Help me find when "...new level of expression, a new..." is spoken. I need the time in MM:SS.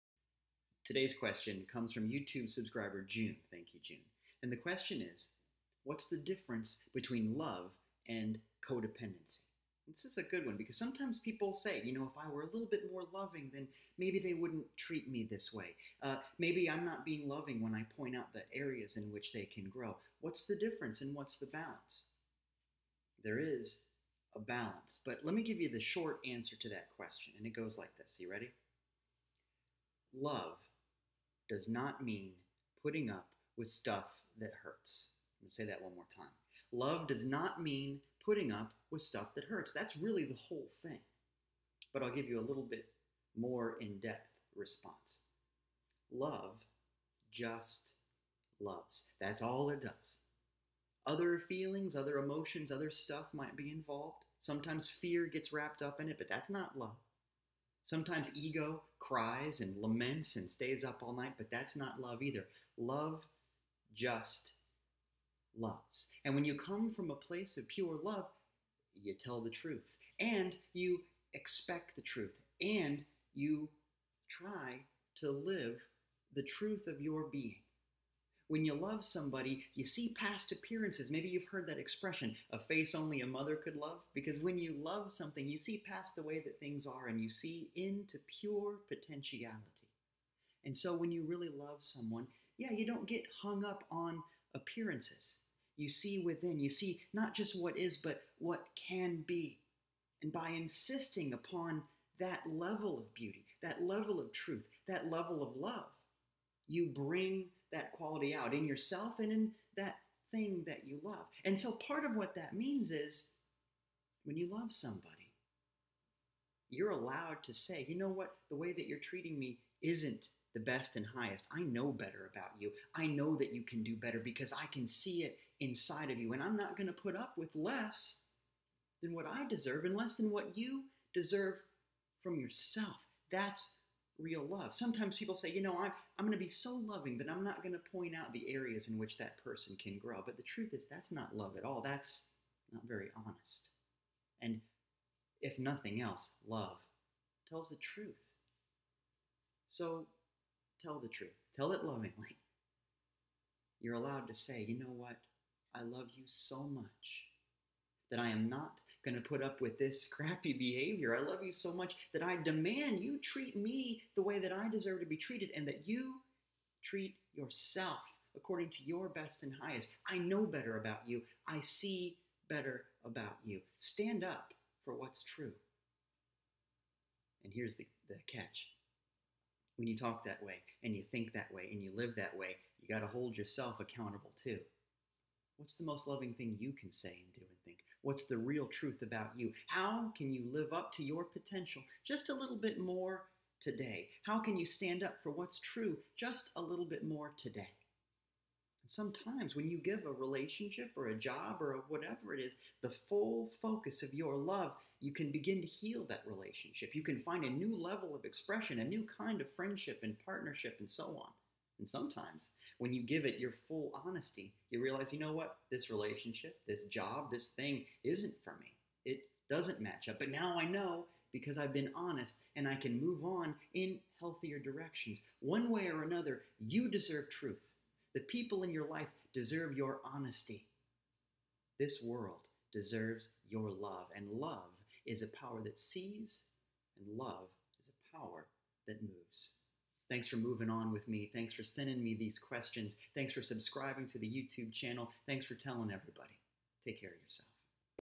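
03:27.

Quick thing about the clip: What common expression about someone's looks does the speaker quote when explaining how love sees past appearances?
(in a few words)
A face only a mother could love.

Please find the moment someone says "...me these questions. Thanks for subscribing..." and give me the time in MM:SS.
04:02.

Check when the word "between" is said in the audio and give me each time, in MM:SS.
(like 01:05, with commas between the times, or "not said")
00:06.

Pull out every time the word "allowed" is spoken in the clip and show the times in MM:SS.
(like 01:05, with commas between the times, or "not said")
01:56, 02:33.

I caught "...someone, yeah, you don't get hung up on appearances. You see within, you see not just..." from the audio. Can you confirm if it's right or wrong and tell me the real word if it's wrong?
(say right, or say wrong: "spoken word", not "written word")
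right.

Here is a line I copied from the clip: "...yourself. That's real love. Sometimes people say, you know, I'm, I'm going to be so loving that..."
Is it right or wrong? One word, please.
right.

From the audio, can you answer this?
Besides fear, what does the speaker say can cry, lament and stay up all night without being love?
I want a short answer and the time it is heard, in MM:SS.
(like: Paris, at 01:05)
Ego, at 00:58.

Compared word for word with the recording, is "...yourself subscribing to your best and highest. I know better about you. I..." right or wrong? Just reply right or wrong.
wrong.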